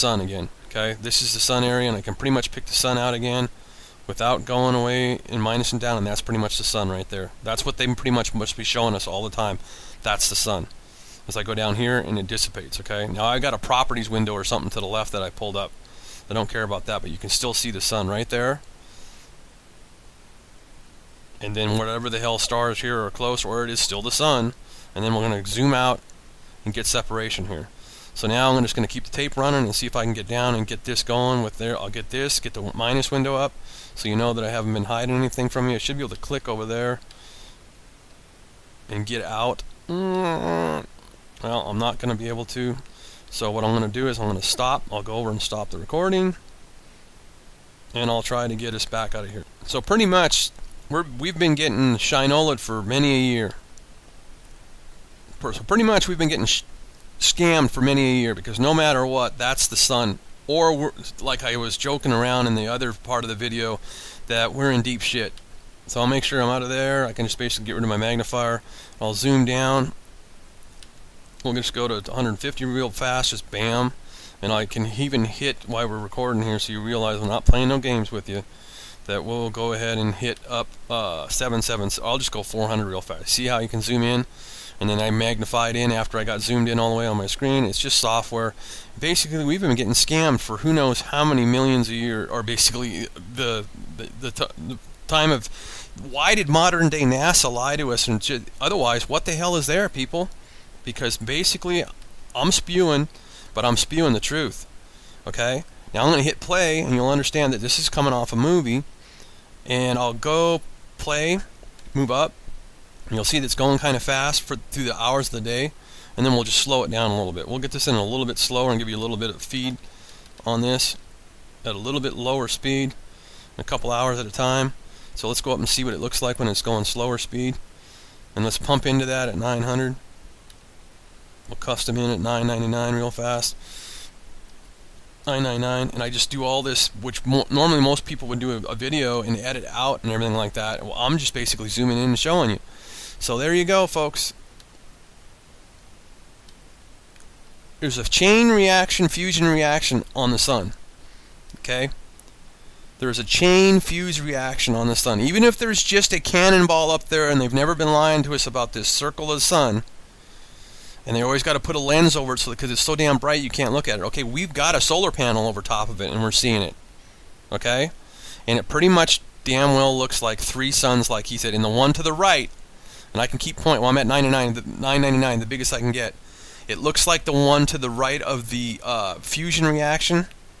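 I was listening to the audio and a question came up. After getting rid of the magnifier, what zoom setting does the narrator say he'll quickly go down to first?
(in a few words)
150.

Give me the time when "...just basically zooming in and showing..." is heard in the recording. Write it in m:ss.
2:21.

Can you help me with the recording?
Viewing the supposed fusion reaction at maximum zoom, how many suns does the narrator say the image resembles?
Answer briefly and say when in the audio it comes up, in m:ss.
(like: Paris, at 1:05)
3, at 2:50.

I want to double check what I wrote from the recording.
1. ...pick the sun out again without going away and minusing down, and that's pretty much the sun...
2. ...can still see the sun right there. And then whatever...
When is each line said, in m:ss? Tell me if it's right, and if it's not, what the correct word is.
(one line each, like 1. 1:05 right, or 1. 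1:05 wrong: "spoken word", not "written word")
1. 0:02 right
2. 0:17 right.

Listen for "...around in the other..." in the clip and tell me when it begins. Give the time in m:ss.
1:02.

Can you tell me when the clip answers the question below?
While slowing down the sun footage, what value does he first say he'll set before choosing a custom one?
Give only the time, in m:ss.
2:09.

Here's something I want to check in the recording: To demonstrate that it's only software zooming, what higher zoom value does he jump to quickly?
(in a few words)
400.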